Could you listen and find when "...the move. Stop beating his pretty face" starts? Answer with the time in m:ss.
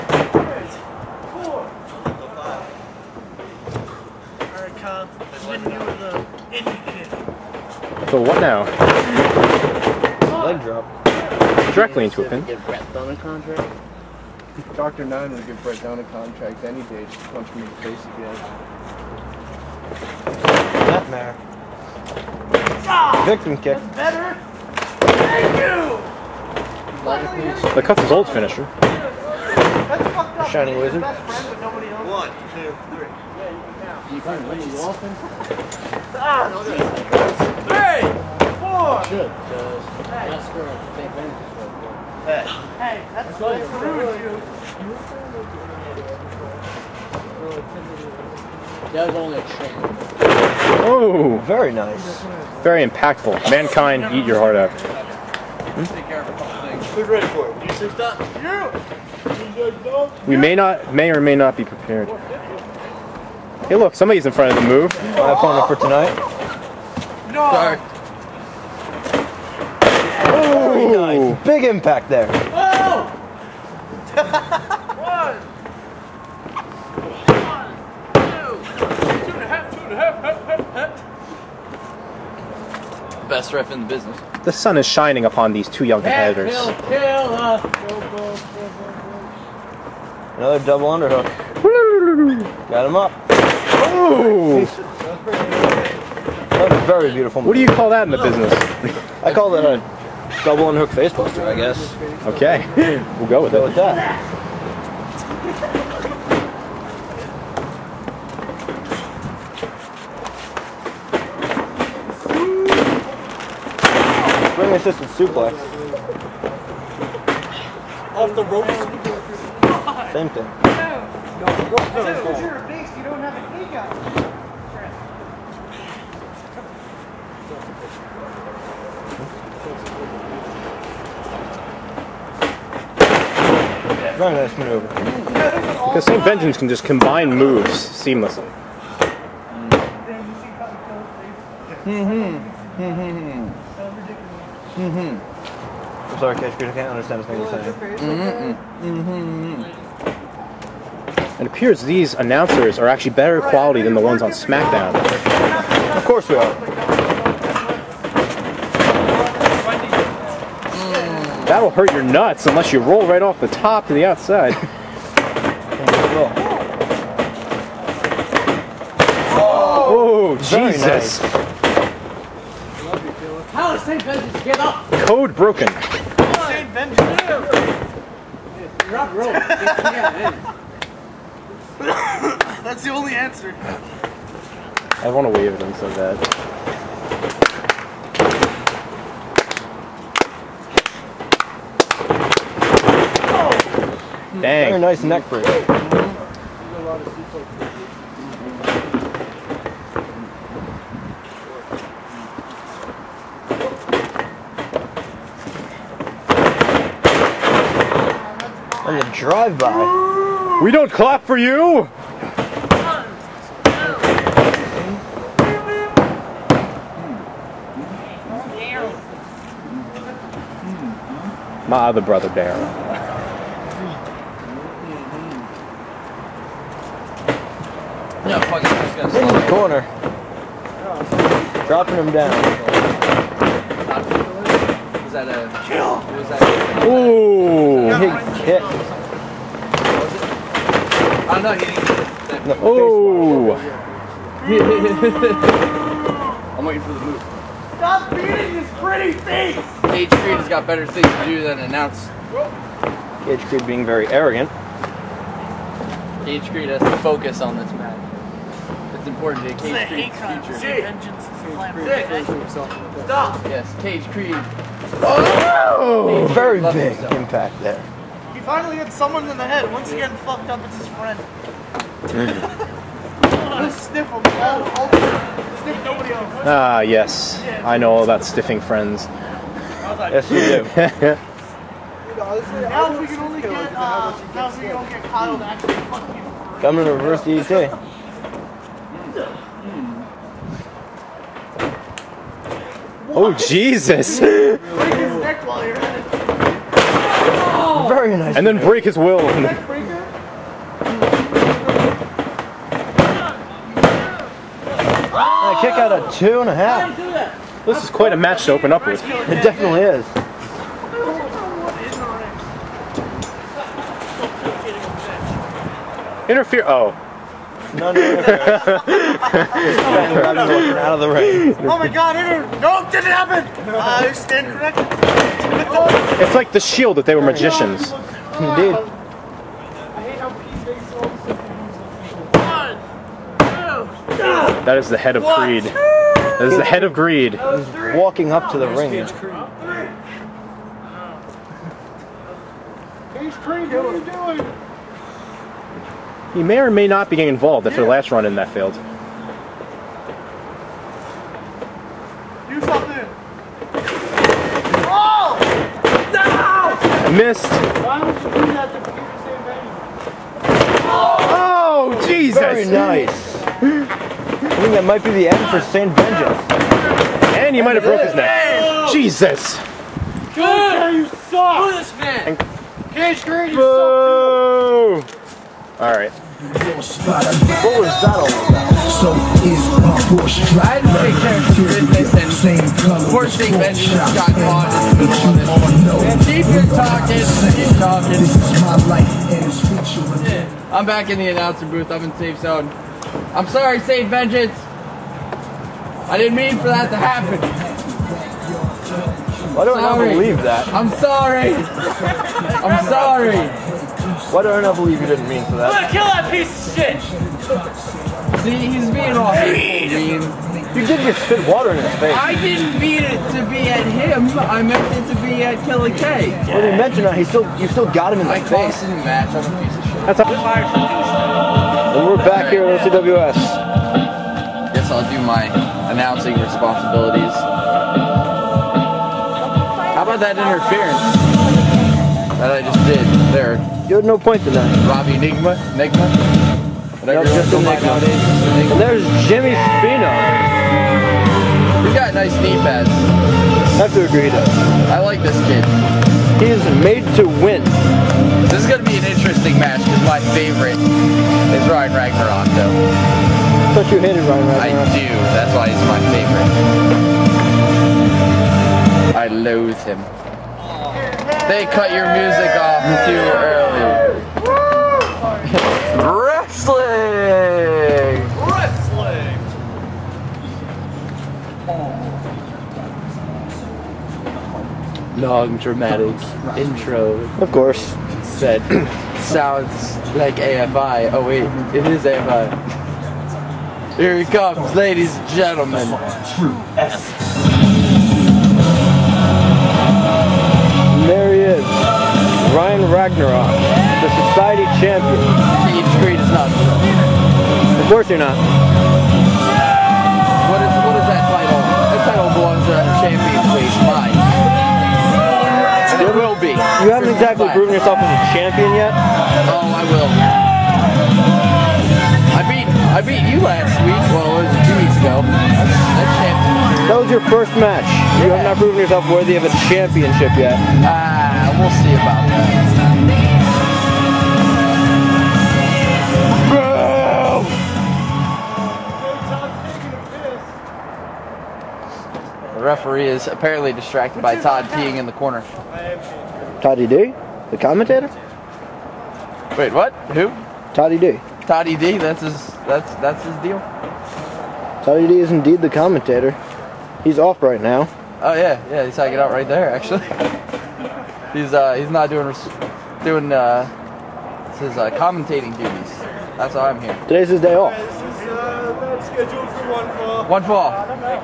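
4:06.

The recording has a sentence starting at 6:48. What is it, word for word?
See, he's being all hateful, mean.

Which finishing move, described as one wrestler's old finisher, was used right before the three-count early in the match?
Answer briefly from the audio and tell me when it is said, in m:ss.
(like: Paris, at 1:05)
The Shining Wizard, at 0:28.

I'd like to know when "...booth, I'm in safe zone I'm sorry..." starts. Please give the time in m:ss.
6:31.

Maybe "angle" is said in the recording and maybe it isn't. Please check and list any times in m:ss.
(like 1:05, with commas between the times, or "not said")
not said.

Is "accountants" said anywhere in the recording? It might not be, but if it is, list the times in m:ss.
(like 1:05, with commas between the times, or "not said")
not said.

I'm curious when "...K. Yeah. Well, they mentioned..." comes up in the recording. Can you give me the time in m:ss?
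6:55.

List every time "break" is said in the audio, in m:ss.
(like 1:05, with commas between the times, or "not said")
3:15, 4:58.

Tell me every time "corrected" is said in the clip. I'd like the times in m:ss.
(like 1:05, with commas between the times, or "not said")
5:24.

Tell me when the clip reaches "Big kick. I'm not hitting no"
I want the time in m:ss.
3:57.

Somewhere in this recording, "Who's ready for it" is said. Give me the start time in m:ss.
0:56.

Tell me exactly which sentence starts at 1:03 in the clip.
Hey, look, somebody's in front of the move.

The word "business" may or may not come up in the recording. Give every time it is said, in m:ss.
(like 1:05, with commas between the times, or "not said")
1:23, 1:38.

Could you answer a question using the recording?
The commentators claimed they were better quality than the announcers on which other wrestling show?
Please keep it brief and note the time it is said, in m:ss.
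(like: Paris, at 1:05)
SmackDown, at 2:34.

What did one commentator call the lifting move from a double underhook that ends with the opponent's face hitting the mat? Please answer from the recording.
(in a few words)
double underhook facebuster.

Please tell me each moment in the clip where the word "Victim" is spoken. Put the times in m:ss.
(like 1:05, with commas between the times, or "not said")
0:23.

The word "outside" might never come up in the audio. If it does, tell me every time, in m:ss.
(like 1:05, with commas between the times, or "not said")
2:44.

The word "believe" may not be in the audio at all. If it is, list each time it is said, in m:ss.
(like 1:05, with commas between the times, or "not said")
6:39, 6:44.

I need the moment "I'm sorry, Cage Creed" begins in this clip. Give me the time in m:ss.
2:26.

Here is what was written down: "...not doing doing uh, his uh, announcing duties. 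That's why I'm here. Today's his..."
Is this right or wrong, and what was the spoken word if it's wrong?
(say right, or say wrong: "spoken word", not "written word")
wrong: "commentating", not "announcing".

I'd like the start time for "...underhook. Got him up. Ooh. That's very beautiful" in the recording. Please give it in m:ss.
1:30.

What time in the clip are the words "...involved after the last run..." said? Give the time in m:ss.
5:47.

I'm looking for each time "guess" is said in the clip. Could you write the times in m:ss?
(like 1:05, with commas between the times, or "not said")
1:41, 7:04.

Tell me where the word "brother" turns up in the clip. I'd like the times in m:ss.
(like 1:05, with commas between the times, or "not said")
3:42.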